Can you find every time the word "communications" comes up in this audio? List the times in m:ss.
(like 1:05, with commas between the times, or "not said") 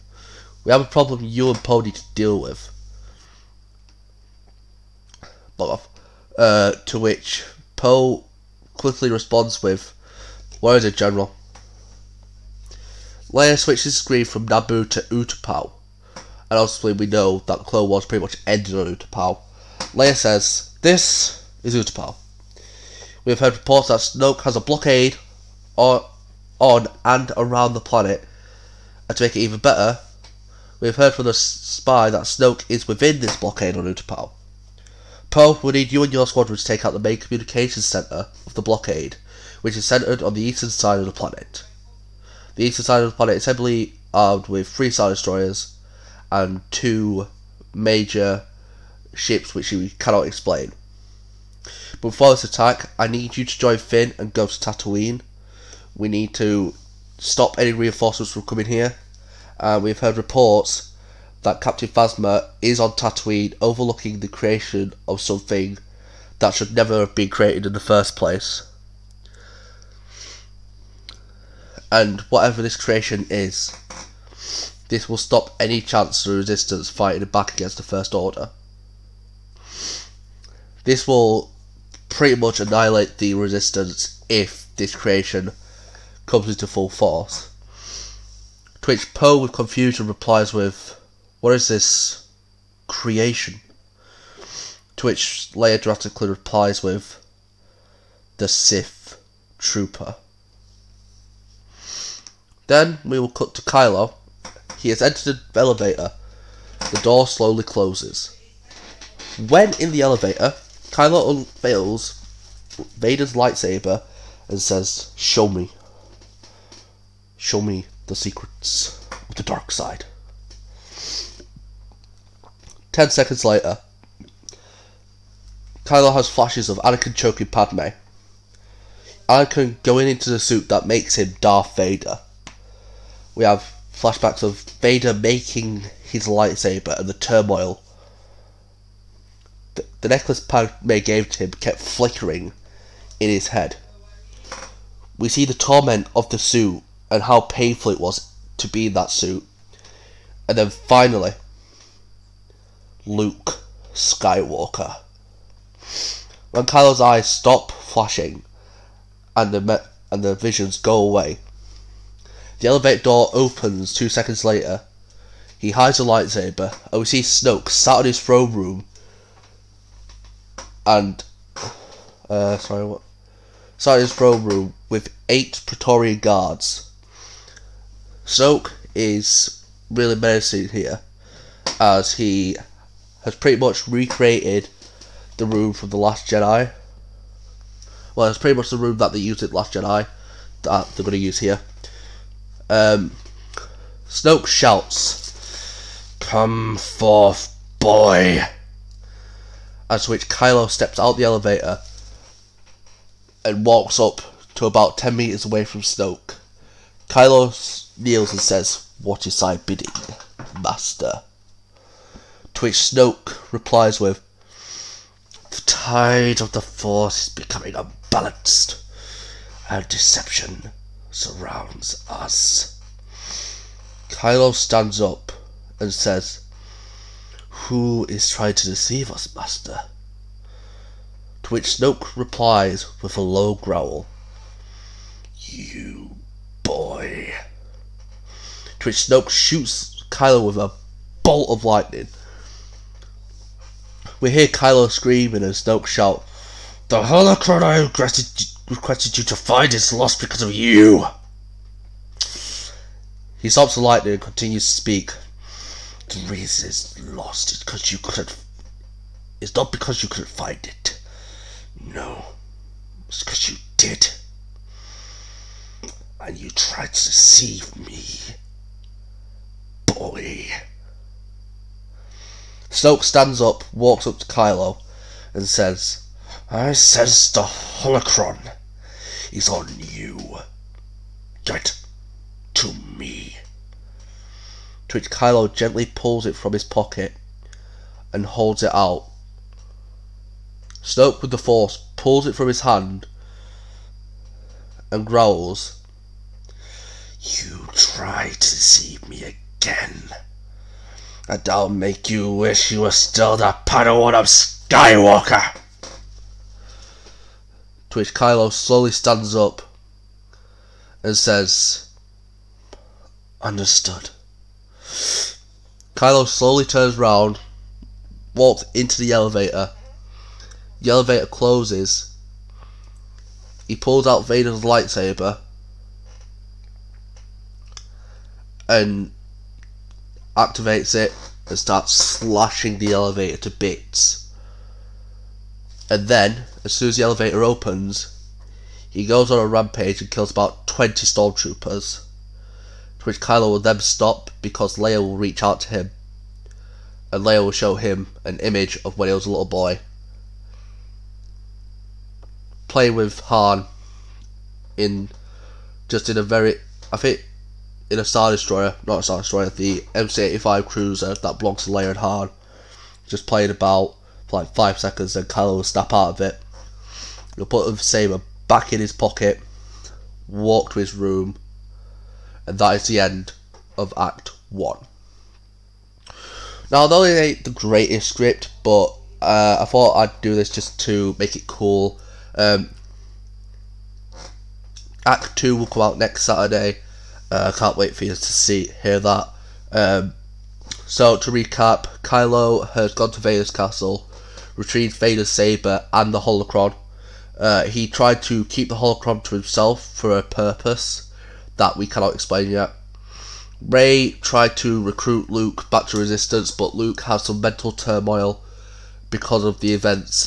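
0:37.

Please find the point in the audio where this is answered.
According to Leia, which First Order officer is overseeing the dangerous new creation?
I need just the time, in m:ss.
1:01.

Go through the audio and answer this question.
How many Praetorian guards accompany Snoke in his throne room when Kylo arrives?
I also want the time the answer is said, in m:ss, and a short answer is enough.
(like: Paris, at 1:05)
8, at 2:55.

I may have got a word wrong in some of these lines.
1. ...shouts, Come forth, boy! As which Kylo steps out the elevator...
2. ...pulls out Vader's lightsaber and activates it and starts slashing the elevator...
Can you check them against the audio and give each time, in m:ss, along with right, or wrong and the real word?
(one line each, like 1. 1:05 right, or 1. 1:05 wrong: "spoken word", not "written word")
1. 3:14 right
2. 5:23 right.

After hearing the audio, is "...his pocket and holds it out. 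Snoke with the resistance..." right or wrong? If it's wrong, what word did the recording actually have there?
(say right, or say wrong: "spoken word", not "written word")
wrong: "force", not "resistance".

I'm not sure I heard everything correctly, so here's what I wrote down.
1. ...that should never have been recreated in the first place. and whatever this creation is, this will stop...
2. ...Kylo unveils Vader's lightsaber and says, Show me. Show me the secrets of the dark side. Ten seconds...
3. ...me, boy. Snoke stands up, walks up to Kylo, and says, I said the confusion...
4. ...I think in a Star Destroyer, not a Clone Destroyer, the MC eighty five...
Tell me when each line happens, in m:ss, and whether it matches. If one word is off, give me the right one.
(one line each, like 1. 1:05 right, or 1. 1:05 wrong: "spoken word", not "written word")
1. 1:06 wrong: "created", not "recreated"
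2. 1:50 right
3. 4:27 wrong: "holocron", not "confusion"
4. 5:56 wrong: "Star", not "Clone".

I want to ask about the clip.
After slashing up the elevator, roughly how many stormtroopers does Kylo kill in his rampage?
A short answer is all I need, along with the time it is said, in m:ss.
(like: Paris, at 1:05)
20, at 5:40.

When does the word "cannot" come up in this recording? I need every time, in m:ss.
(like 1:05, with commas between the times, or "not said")
0:49, 6:41.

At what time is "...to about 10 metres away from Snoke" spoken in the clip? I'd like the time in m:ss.
3:24.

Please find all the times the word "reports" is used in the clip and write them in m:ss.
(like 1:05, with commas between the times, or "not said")
0:23, 1:00.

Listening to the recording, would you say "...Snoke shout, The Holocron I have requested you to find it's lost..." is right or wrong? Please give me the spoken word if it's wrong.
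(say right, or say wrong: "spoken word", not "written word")
right.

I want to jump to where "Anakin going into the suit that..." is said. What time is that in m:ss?
2:09.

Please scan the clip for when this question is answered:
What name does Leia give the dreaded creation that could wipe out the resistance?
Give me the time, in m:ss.
1:38.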